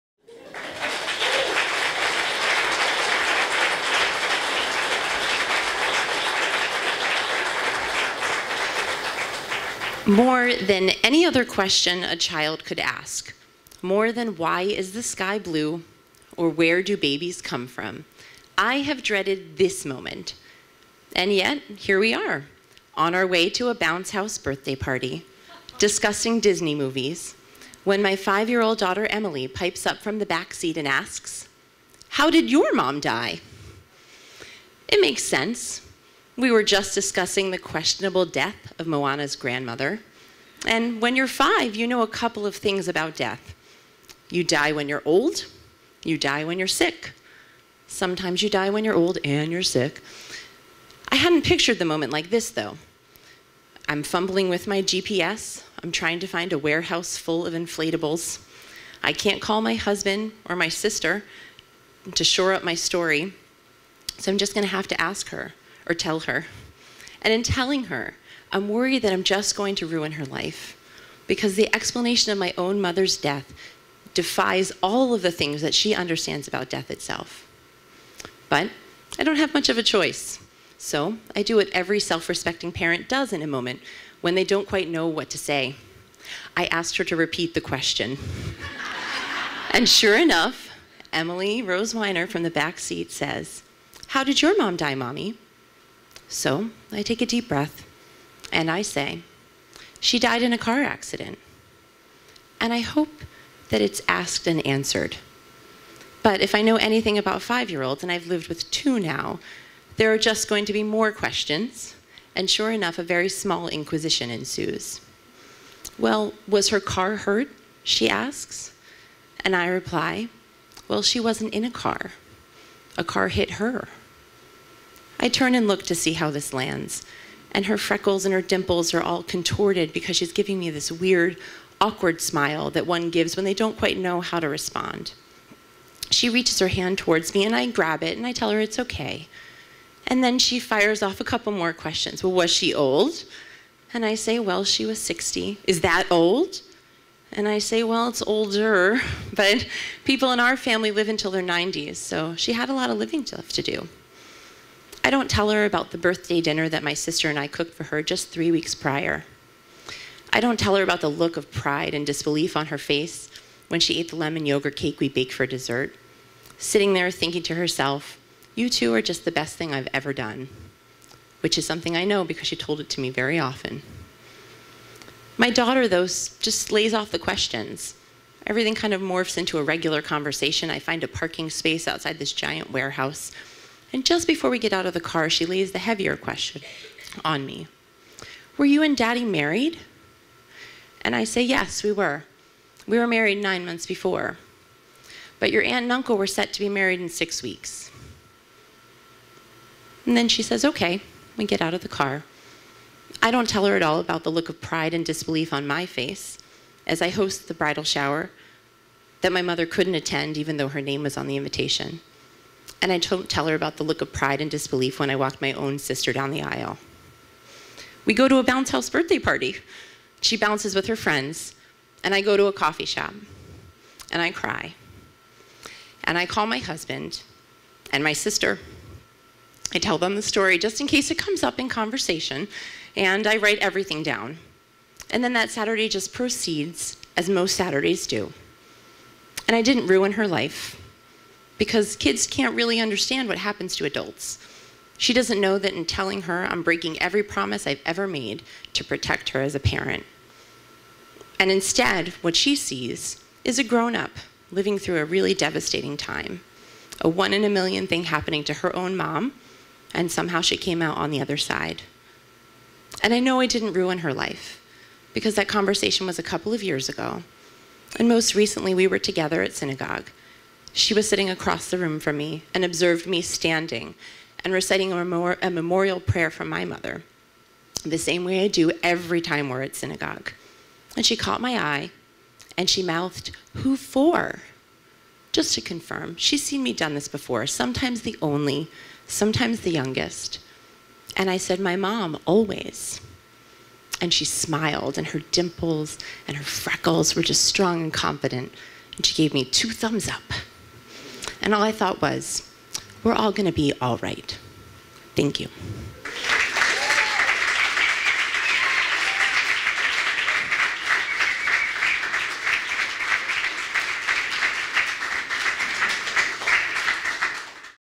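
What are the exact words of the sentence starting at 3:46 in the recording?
And I call my husband and my sister.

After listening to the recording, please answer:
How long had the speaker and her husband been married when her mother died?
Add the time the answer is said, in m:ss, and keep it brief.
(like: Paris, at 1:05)
9 months, at 3:13.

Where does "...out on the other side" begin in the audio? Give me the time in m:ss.
4:20.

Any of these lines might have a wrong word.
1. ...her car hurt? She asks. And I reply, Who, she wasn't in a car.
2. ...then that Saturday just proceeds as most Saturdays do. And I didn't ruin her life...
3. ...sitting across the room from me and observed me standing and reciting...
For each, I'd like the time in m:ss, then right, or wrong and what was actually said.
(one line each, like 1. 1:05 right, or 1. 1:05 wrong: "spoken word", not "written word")
1. 1:56 wrong: "Well", not "Who"
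2. 3:55 right
3. 4:31 right.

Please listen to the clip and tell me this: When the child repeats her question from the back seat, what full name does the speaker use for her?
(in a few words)
Emily Rose Weiner.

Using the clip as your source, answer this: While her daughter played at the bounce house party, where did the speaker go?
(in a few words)
A coffee shop.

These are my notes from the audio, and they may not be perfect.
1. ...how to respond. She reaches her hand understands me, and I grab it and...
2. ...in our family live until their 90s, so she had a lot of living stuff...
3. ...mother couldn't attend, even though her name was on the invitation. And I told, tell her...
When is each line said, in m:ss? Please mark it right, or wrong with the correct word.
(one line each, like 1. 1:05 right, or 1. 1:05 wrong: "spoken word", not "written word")
1. 2:14 wrong: "towards", not "understands"
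2. 2:30 right
3. 3:29 right.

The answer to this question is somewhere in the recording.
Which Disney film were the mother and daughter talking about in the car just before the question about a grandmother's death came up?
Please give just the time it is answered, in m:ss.
0:38.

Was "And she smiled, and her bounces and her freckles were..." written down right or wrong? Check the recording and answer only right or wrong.
wrong.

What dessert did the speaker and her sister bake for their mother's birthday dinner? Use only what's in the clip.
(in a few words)
Lemon yogurt cake.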